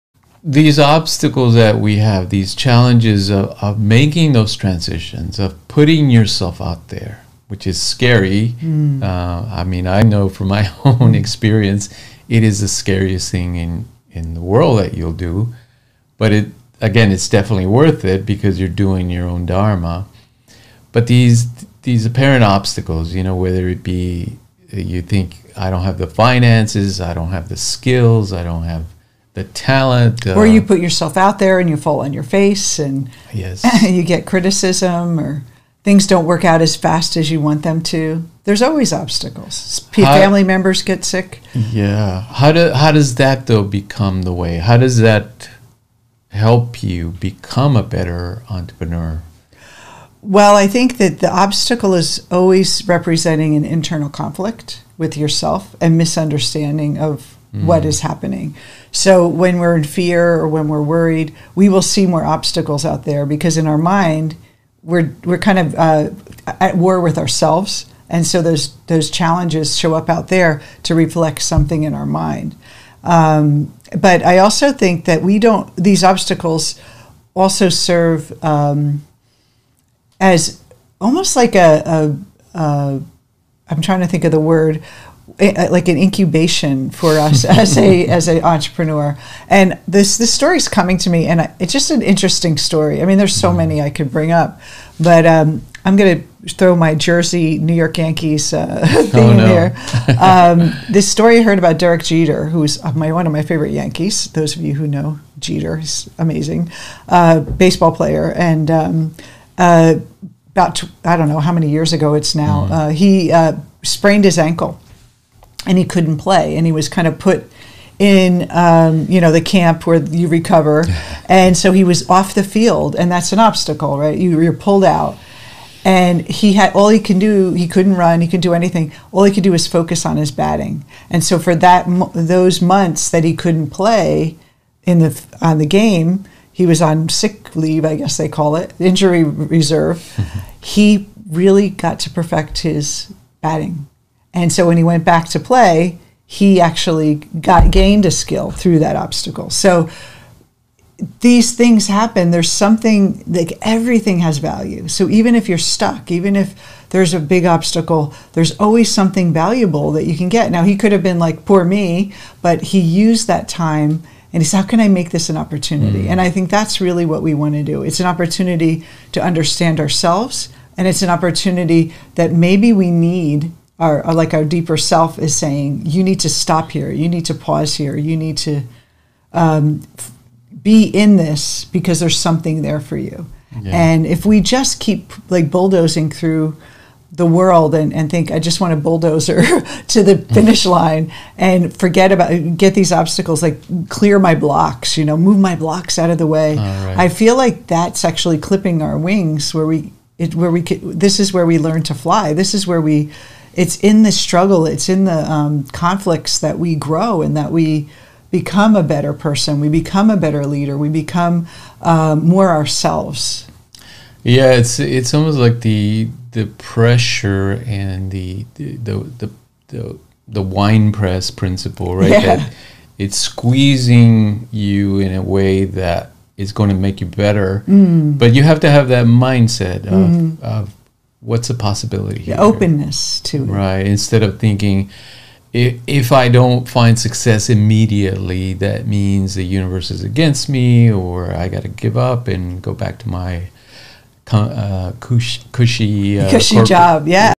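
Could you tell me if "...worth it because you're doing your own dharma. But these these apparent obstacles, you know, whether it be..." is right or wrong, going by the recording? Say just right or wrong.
right.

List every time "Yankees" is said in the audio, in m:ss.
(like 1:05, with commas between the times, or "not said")
1:37, 1:43.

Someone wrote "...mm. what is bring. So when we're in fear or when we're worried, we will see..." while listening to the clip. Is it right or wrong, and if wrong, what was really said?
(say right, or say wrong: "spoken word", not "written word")
wrong: "happening", not "bring".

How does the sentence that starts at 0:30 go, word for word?
Uh, or you put yourself out there and you fall on your face and yes.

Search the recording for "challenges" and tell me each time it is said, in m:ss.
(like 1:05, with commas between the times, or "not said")
0:02, 1:09.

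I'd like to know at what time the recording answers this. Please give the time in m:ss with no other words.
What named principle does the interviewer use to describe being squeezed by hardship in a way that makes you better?
3:40.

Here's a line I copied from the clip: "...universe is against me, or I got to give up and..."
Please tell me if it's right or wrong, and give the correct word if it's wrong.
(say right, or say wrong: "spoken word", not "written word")
right.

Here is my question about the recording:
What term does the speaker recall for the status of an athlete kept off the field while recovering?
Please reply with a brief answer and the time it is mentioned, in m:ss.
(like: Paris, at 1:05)
injury reserve, at 2:18.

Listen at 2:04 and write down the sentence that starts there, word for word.
You, you're pulled out, and he had all he can do.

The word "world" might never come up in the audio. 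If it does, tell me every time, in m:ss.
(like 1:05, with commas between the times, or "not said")
0:14, 3:07.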